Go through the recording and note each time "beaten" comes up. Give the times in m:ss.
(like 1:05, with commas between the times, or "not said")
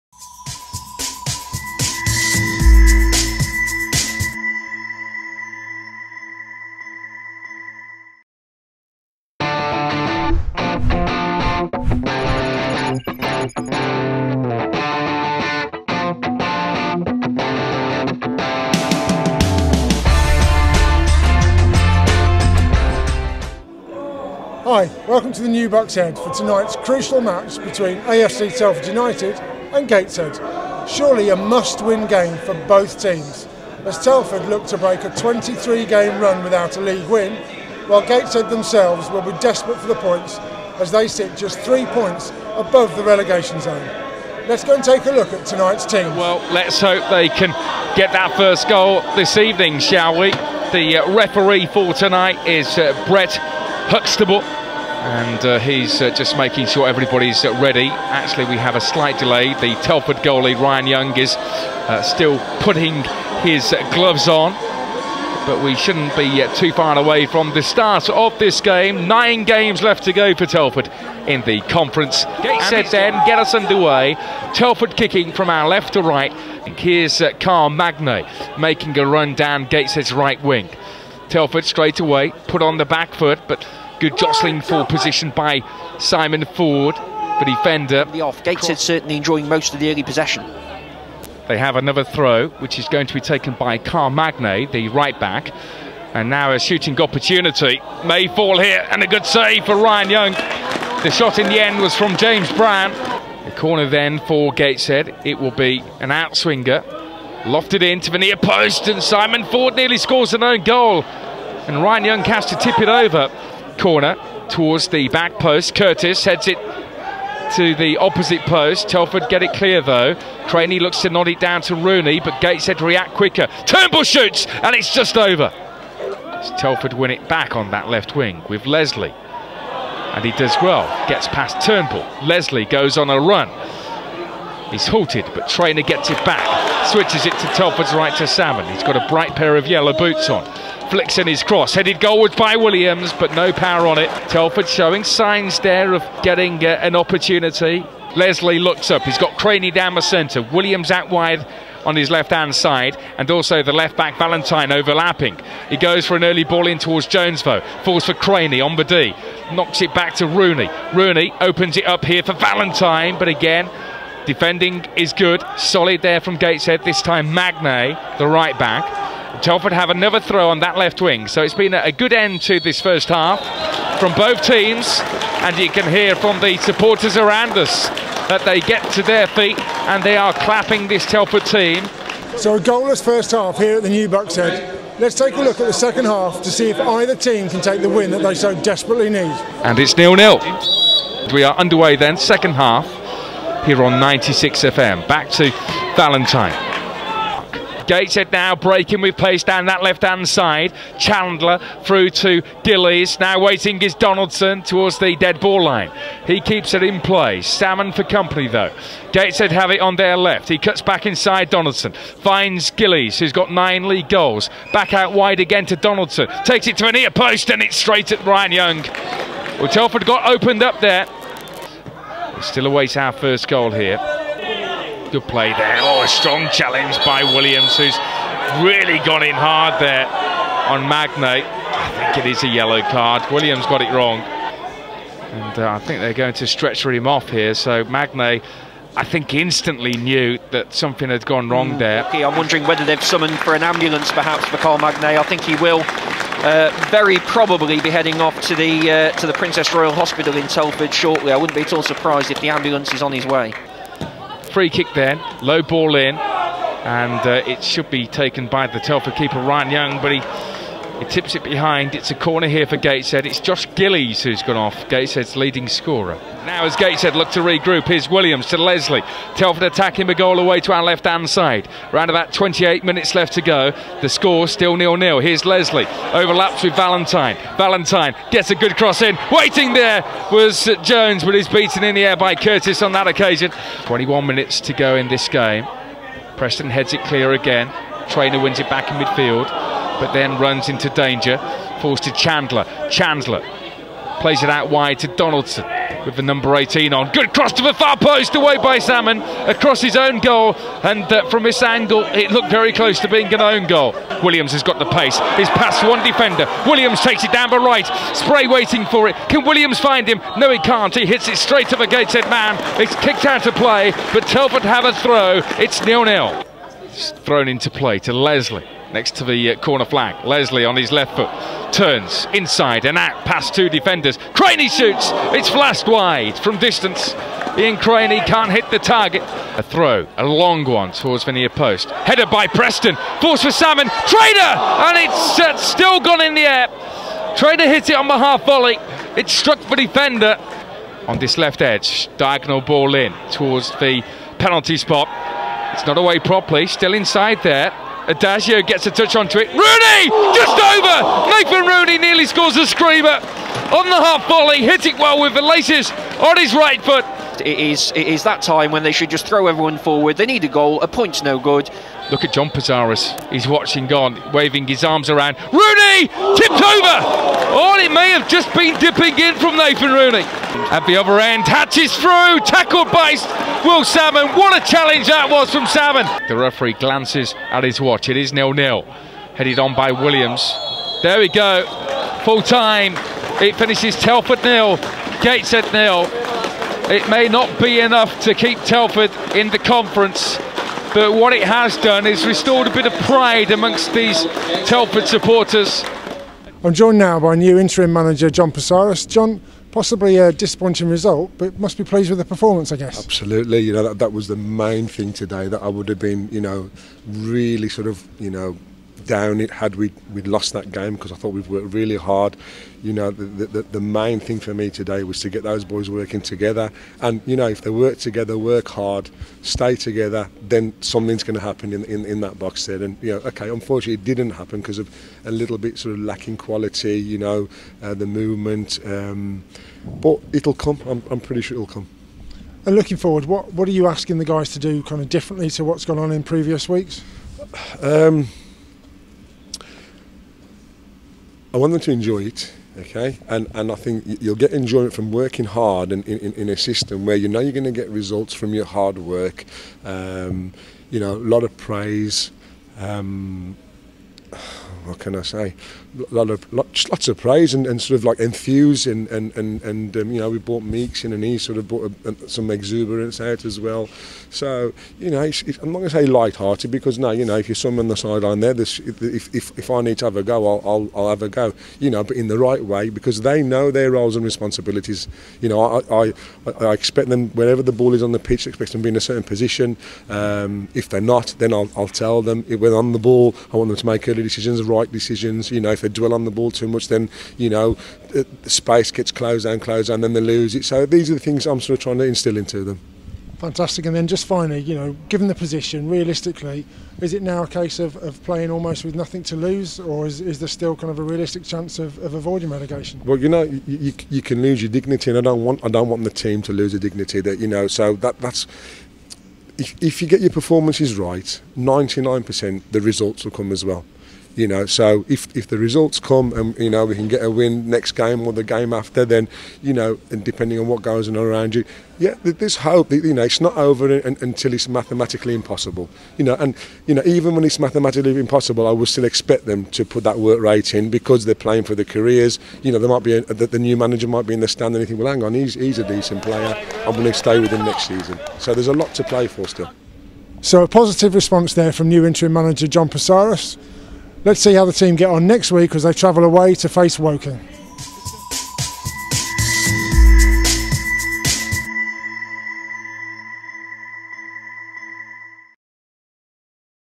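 4:41.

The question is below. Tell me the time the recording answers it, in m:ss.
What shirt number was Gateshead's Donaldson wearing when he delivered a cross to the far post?
4:56.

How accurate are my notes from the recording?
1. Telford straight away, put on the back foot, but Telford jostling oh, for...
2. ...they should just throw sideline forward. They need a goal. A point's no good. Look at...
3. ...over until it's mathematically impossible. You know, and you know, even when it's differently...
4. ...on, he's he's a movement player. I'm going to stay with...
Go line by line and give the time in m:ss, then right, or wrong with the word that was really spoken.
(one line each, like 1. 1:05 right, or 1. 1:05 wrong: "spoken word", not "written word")
1. 1:21 wrong: "Good", not "Telford"
2. 5:58 wrong: "everyone", not "sideline"
3. 8:43 wrong: "mathematically", not "differently"
4. 8:55 wrong: "decent", not "movement".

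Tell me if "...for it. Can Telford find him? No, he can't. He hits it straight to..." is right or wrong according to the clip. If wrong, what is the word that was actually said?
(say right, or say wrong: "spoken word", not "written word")
wrong: "Williams", not "Telford".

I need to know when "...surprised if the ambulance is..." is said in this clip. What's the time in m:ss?
4:11.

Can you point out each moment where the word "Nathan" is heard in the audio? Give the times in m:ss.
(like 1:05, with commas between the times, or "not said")
5:51, 6:09.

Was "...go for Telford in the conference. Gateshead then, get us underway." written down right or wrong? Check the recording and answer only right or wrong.
right.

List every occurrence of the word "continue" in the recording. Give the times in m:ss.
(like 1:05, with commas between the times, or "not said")
not said.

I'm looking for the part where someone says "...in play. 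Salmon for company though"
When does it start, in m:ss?
3:26.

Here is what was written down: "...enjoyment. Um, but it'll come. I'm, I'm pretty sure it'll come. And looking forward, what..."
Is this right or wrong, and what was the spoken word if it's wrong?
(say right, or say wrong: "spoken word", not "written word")
wrong: "movement", not "enjoyment".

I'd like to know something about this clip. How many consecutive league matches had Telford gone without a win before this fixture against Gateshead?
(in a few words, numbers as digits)
23.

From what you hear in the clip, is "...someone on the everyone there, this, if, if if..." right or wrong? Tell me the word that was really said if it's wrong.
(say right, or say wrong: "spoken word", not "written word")
wrong: "sideline", not "everyone".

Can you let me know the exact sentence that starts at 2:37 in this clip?
Falls for Craney on the D.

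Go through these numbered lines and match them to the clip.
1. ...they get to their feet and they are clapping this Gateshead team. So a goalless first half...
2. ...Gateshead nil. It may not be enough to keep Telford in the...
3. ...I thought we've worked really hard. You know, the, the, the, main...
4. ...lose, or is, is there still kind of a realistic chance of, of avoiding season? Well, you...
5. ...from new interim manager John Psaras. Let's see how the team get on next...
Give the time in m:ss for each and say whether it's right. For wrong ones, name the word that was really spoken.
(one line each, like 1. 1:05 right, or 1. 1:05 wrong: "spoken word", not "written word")
1. 2:58 wrong: "Telford", not "Gateshead"
2. 6:25 right
3. 6:51 right
4. 8:19 wrong: "relegation", not "season"
5. 9:01 right.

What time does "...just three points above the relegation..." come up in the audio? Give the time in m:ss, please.
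0:41.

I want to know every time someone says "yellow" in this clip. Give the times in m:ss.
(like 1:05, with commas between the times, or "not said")
2:19, 3:52.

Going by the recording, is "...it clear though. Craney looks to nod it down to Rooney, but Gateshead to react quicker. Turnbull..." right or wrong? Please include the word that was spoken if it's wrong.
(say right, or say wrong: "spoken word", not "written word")
right.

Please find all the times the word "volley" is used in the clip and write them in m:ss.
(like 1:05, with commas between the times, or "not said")
5:38, 5:54.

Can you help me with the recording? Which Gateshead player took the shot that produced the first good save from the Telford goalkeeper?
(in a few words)
James Brown.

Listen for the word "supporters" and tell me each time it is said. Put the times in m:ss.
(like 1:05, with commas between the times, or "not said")
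2:56, 6:35.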